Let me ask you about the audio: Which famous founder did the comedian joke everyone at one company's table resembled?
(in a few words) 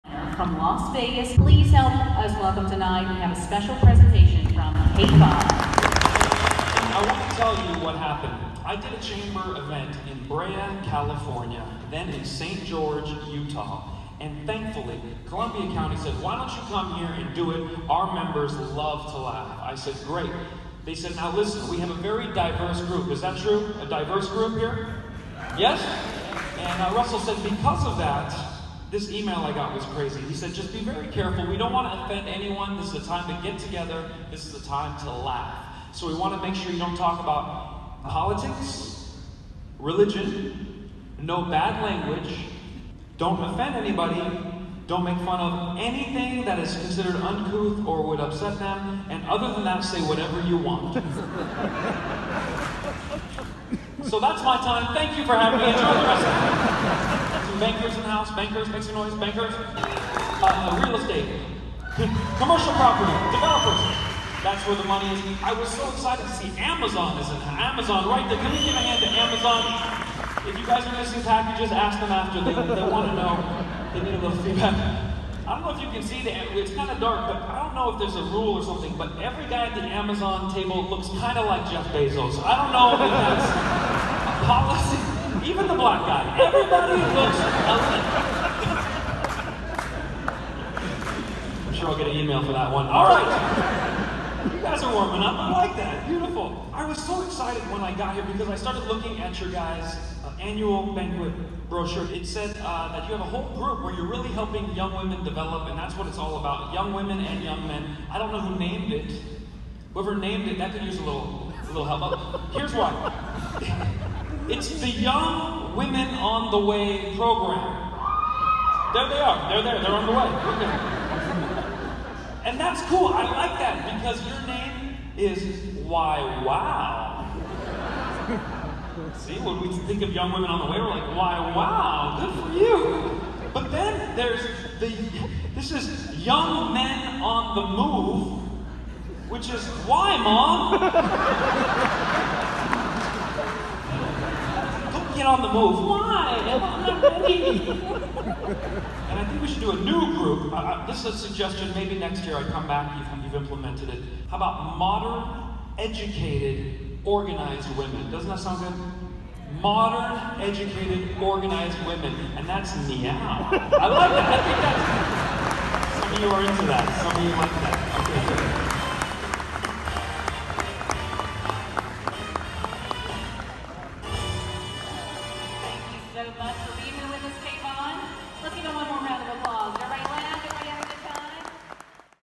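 Jeff Bezos.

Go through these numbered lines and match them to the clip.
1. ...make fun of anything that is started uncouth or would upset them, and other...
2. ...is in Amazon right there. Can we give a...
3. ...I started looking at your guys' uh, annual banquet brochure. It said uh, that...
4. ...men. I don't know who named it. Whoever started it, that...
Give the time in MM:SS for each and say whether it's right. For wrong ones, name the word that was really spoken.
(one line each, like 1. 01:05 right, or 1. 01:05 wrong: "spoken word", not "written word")
1. 00:45 wrong: "considered", not "started"
2. 01:07 right
3. 01:38 right
4. 01:47 wrong: "named", not "started".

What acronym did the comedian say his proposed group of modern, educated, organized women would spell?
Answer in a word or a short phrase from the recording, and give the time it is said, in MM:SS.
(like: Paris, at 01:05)
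MEOW, at 02:42.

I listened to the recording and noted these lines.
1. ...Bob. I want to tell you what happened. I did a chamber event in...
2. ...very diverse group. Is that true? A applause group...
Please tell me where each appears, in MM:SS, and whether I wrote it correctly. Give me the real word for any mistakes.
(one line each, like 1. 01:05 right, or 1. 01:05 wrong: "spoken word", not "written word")
1. 00:05 right
2. 00:22 wrong: "diverse", not "applause".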